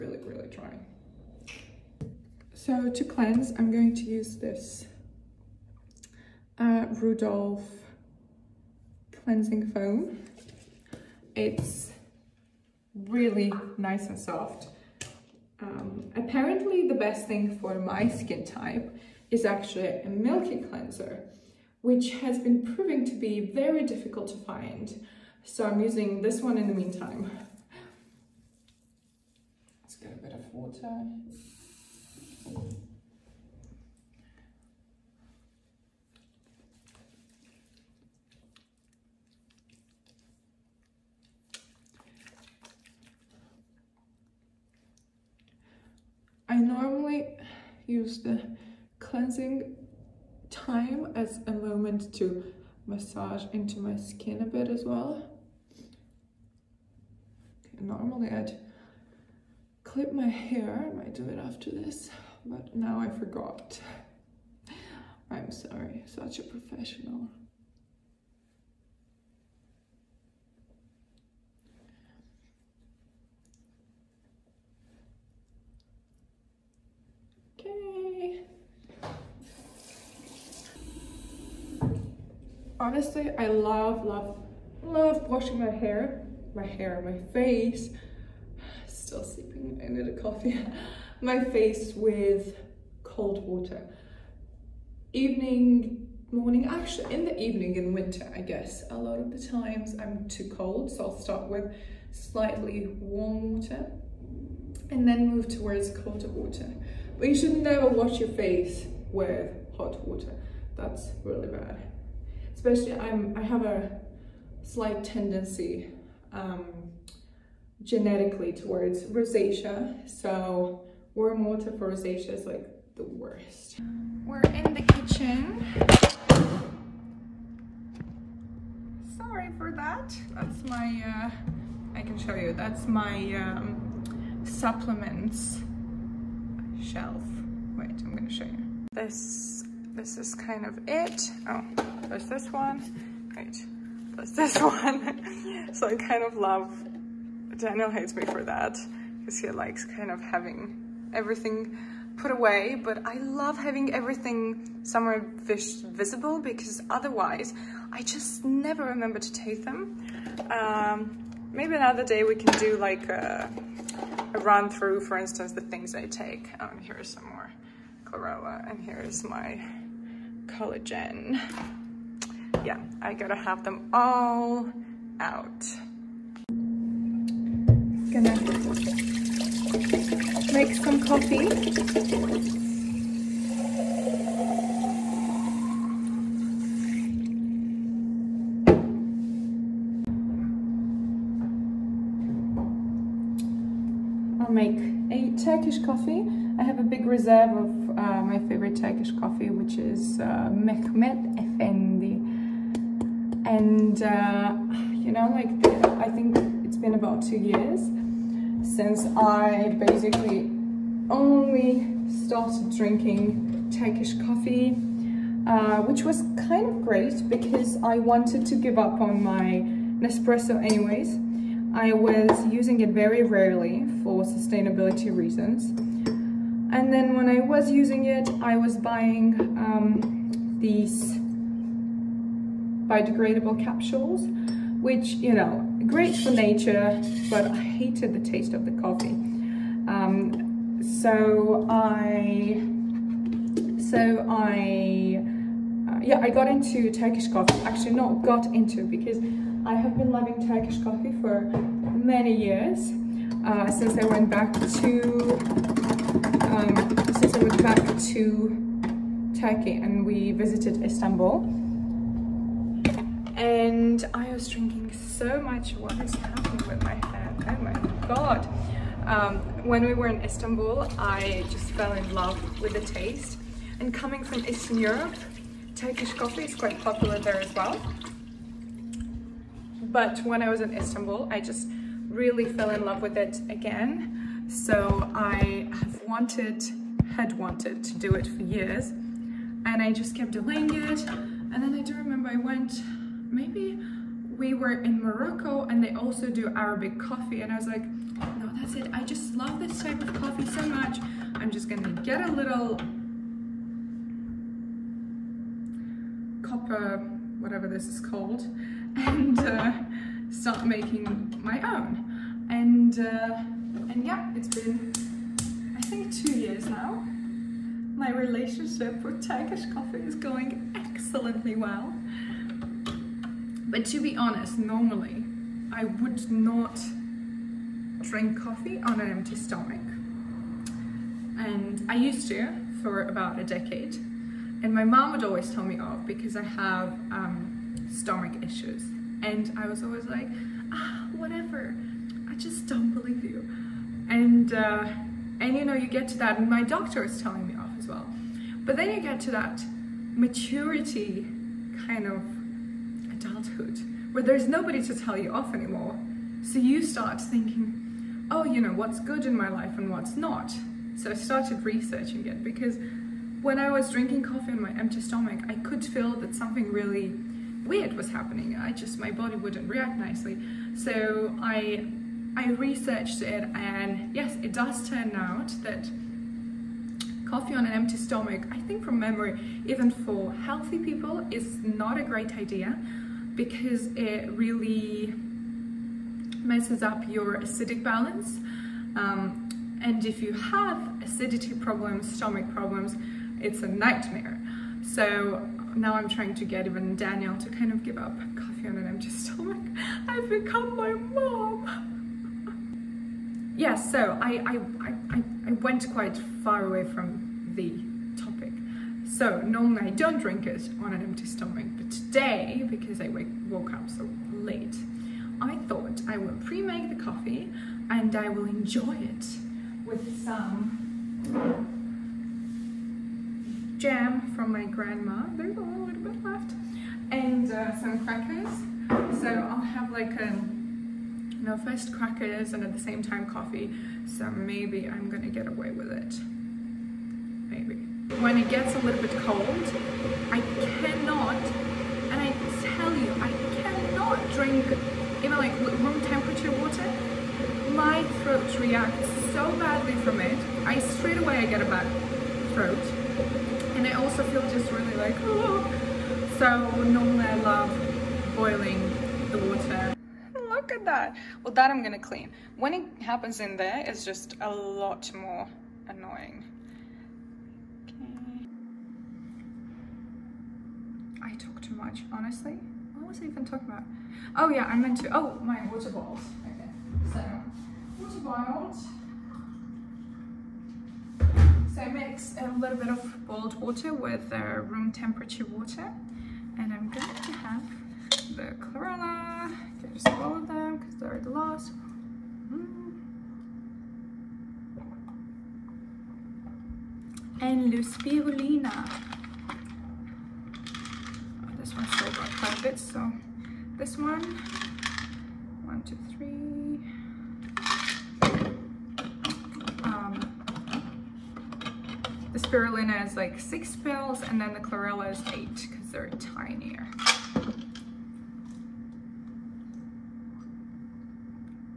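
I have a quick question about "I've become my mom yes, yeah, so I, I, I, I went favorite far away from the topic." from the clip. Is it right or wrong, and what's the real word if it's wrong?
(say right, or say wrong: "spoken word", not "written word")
wrong: "quite", not "favorite".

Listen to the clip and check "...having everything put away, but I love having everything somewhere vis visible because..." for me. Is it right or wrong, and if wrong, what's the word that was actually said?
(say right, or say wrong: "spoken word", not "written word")
right.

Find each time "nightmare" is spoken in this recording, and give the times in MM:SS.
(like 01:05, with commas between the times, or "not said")
06:33.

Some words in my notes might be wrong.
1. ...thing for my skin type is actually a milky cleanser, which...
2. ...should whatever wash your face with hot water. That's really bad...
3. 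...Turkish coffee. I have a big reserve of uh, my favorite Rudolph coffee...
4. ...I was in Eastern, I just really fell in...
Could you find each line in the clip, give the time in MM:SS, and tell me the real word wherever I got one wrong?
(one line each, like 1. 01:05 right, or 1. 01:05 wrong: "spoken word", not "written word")
1. 00:17 right
2. 01:47 wrong: "never", not "whatever"
3. 03:15 wrong: "Turkish", not "Rudolph"
4. 04:40 wrong: "Istanbul", not "Eastern".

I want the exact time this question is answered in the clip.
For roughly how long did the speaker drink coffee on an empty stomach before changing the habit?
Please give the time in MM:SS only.
05:33.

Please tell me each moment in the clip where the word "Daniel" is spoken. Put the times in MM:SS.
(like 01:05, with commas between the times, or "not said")
02:27, 06:36.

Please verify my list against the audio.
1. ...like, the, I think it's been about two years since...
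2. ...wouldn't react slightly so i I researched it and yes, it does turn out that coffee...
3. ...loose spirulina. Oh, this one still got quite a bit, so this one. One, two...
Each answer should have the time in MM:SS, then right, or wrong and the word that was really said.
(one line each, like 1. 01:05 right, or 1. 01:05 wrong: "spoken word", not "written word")
1. 03:25 right
2. 06:09 wrong: "nicely", not "slightly"
3. 08:17 right.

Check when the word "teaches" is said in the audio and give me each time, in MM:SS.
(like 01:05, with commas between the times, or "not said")
not said.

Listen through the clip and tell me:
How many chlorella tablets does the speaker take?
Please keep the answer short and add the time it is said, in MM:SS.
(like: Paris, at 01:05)
8, at 08:35.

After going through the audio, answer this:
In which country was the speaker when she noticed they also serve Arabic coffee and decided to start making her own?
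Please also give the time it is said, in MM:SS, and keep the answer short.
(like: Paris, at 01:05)
Morocco, at 04:55.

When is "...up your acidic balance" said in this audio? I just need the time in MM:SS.
06:26.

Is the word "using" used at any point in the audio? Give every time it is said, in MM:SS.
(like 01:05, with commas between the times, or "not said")
00:25, 03:42, 03:47.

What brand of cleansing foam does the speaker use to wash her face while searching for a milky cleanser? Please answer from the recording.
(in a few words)
Rudolph.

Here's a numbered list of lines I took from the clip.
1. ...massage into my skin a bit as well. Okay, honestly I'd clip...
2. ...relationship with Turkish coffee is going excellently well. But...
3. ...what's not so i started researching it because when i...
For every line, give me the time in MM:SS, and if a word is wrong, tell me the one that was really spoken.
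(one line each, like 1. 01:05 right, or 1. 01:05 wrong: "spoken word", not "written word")
1. 00:52 wrong: "normally", not "honestly"
2. 05:18 right
3. 05:59 right.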